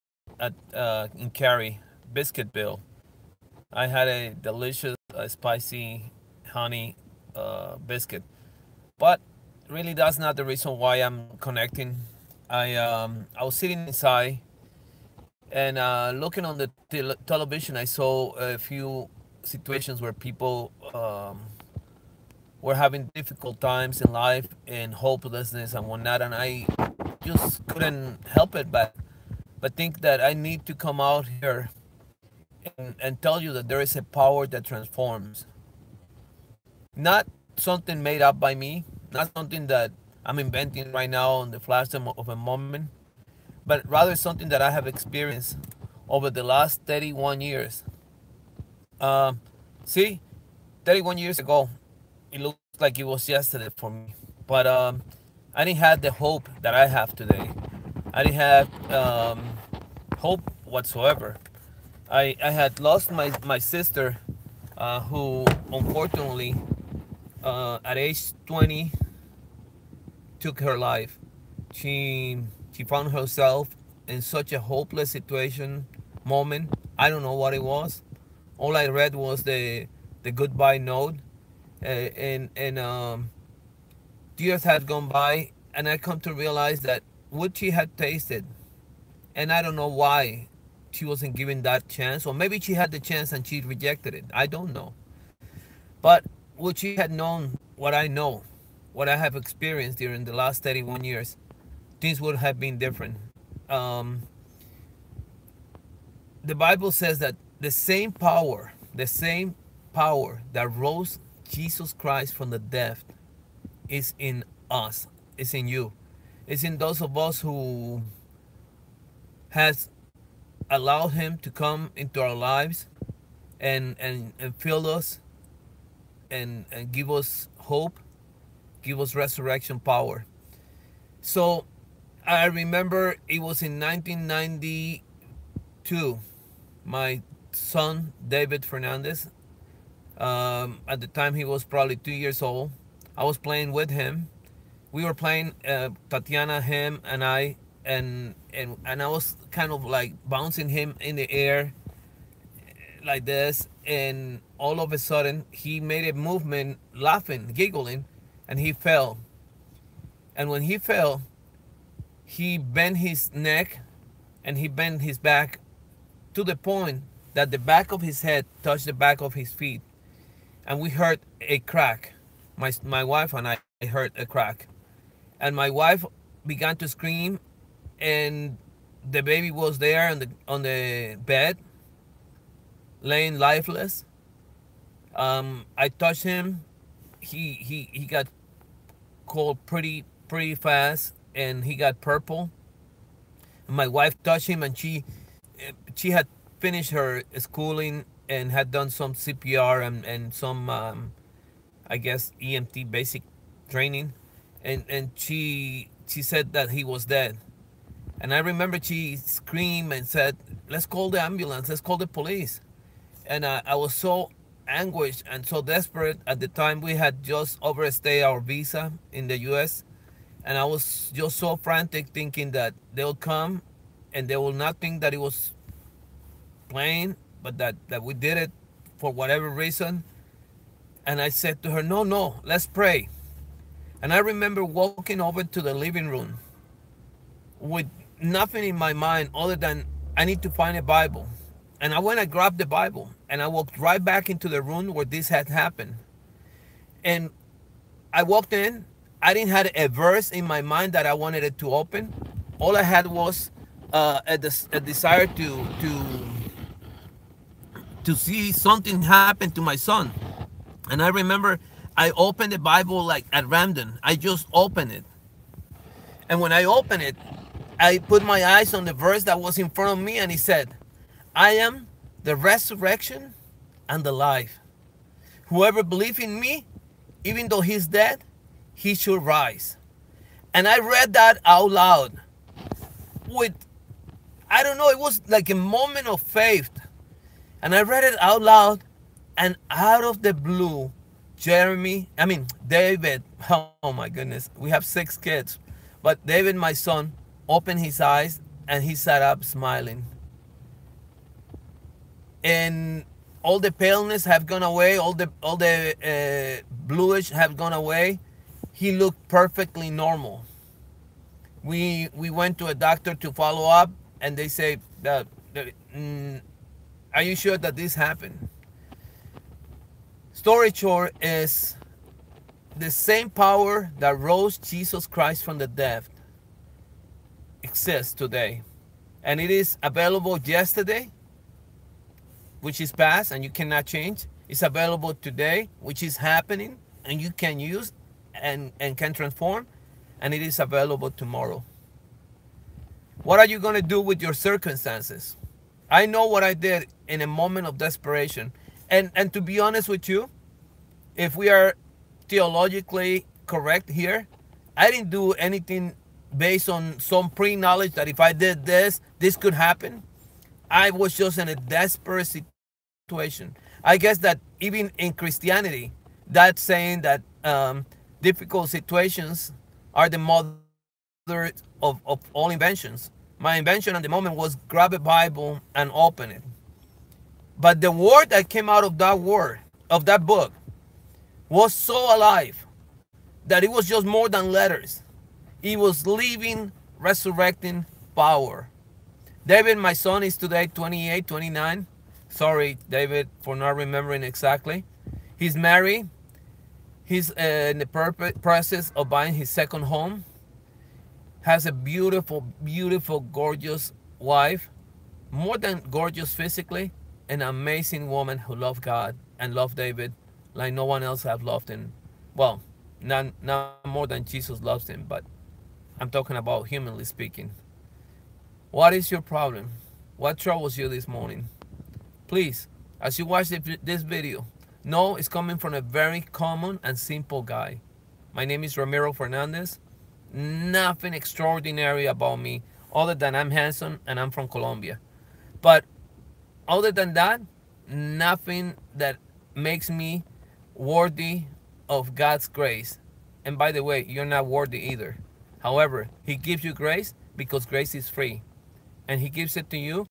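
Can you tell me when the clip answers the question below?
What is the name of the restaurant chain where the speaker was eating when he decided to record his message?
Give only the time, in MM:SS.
00:02.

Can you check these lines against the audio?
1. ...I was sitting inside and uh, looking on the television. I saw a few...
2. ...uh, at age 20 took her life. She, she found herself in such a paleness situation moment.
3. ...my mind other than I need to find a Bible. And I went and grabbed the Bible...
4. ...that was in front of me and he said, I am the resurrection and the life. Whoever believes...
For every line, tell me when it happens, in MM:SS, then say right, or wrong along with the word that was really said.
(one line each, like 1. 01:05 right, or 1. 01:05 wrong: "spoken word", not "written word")
1. 00:13 right
2. 01:07 wrong: "hopeless", not "paleness"
3. 03:58 right
4. 04:29 right.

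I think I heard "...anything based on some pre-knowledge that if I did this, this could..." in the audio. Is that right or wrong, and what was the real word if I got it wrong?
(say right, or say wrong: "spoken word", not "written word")
right.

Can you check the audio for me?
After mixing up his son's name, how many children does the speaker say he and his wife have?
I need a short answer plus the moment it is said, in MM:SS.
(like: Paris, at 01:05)
6, at 04:54.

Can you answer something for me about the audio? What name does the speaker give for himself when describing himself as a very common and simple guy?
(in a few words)
Ramiro Fernandez.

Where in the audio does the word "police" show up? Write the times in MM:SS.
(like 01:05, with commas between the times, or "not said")
03:32.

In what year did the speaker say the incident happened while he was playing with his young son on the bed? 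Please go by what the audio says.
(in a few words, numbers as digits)
1992.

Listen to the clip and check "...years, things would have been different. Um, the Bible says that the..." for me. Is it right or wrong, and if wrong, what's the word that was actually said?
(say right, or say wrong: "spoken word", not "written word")
right.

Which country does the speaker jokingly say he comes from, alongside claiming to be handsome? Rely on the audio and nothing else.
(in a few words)
Colombia.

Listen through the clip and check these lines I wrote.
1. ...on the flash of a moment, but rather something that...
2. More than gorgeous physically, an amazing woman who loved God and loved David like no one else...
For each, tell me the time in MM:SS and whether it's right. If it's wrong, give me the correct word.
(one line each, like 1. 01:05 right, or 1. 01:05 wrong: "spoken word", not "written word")
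1. 00:41 right
2. 06:45 right.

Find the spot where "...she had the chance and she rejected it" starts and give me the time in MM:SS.
01:32.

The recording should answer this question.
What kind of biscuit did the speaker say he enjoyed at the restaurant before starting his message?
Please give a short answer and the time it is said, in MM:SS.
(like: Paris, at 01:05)
spicy honey, at 00:05.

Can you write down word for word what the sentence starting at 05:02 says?
And all the paleness have gone away, all the all the uh, bluish have gone away.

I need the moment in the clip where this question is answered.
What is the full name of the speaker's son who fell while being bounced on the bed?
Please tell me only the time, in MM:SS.
02:18.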